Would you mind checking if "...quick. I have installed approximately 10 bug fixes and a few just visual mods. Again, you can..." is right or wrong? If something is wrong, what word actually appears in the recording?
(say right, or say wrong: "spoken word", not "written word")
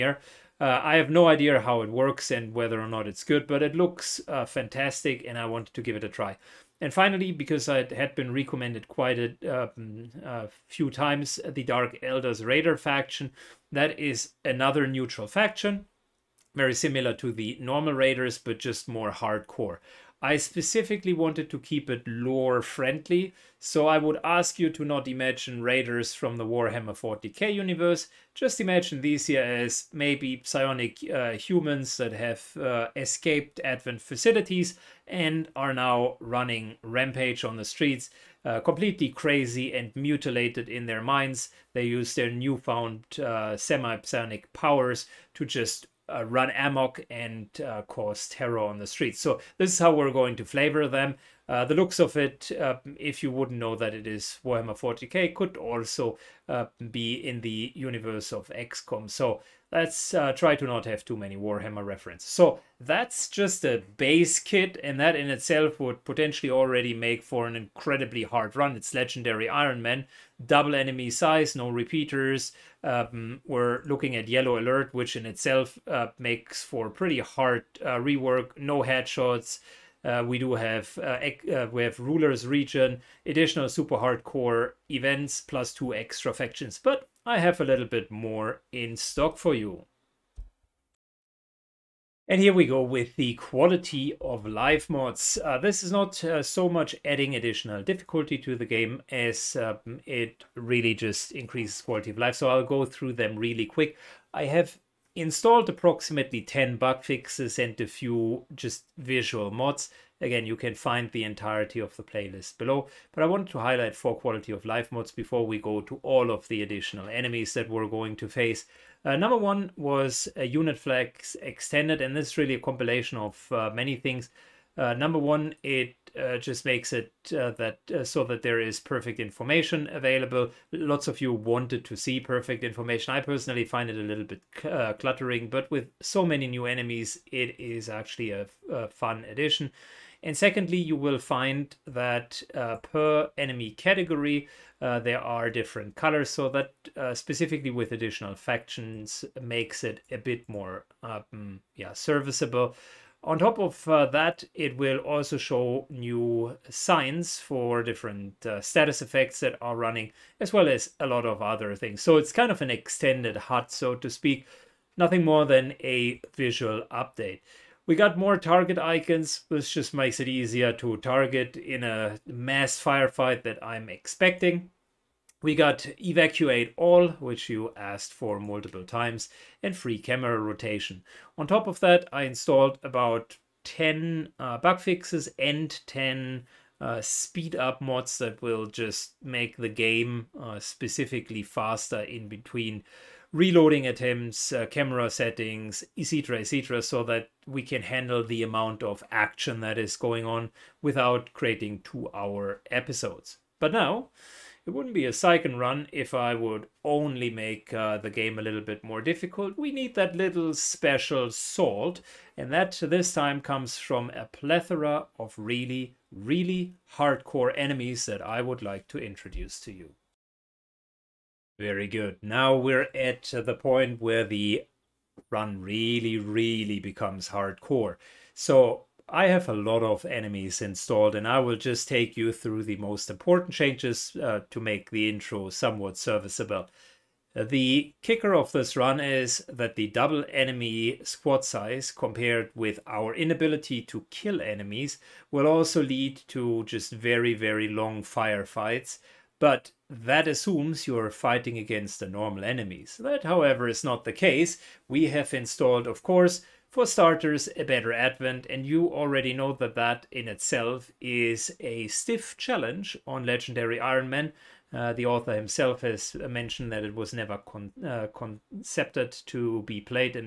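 right.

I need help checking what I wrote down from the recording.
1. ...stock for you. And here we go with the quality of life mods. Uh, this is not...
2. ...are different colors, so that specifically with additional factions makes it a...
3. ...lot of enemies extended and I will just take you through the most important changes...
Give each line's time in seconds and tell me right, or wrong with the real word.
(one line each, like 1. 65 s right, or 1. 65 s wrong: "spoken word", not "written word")
1. 88 s right
2. 145 s right
3. 229 s wrong: "installed", not "extended".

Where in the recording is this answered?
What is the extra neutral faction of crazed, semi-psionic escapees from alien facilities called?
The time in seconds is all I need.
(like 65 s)
11 s.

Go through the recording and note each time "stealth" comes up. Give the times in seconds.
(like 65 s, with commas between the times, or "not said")
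not said.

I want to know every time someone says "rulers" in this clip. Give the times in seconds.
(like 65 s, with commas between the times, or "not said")
81 s.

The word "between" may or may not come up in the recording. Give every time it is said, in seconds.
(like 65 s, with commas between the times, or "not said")
192 s.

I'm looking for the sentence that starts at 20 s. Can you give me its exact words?
I specifically wanted to keep it lore friendly, so I would ask you to not imagine raiders from the Warhammer 40k universe.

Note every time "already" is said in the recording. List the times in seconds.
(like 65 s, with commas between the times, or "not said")
66 s, 258 s.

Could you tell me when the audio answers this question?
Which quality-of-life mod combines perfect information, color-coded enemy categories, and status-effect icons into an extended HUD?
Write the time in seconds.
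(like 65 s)
120 s.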